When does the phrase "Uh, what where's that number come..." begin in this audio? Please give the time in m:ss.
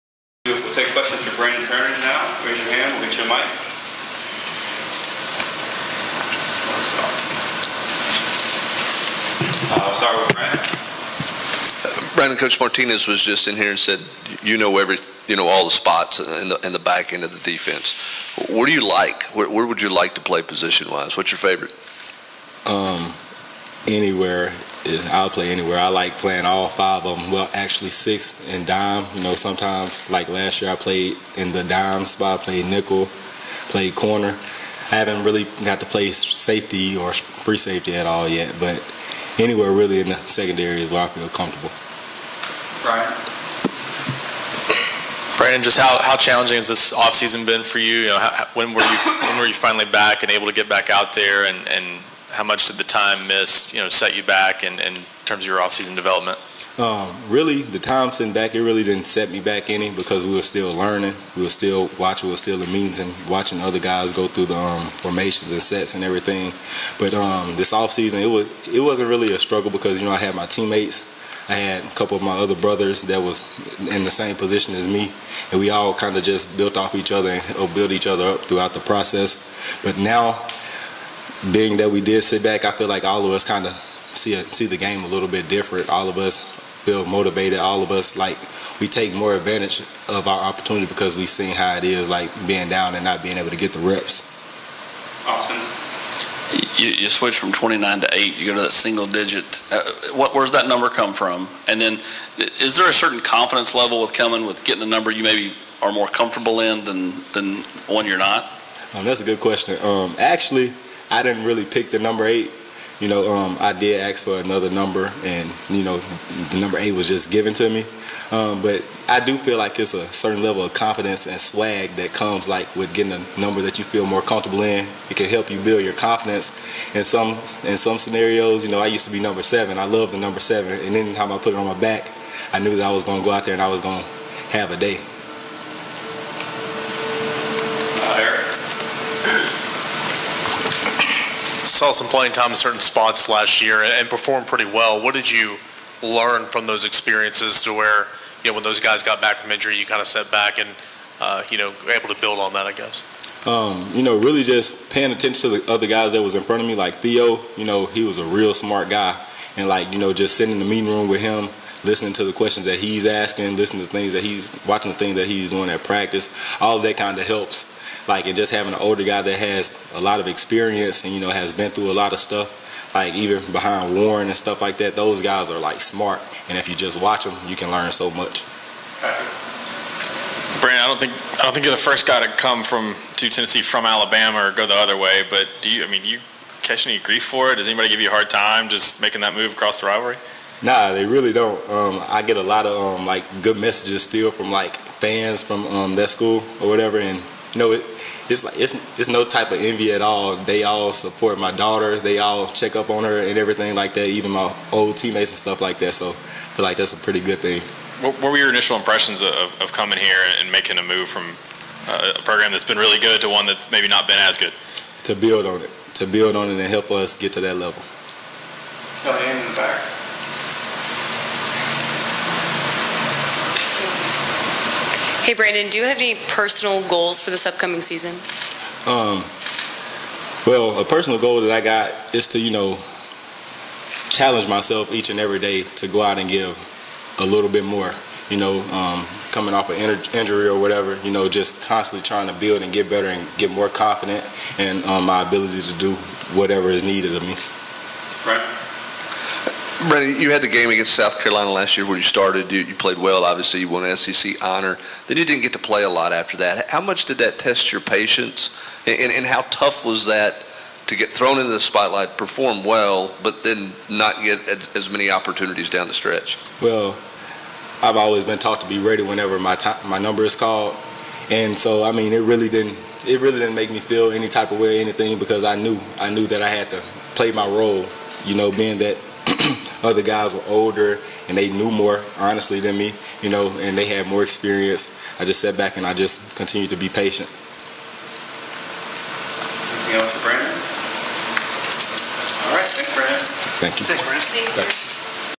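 1:39.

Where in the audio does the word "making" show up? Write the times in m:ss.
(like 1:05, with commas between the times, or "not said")
3:08, 3:30.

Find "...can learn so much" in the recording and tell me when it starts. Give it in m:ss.
2:57.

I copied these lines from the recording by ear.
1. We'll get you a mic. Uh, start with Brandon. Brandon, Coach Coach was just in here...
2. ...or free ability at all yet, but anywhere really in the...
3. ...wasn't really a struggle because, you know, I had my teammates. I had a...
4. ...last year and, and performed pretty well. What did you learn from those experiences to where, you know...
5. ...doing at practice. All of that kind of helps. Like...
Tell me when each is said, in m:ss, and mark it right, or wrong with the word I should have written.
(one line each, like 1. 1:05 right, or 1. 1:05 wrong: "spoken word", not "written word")
1. 0:02 wrong: "Martinez", not "Coach"
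2. 0:36 wrong: "safety", not "ability"
3. 1:08 right
4. 2:23 right
5. 2:45 right.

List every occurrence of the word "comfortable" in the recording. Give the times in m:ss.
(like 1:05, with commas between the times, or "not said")
0:41, 1:46, 2:04.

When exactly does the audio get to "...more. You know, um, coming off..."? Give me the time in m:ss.
3:57.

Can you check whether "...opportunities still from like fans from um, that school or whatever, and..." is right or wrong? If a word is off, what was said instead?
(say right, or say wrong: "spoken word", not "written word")
wrong: "messages", not "opportunities".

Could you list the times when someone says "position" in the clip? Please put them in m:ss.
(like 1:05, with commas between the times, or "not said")
0:20, 1:14.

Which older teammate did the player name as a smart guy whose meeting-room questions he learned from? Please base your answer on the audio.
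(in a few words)
Theo.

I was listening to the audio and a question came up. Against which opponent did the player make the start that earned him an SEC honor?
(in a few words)
South Carolina.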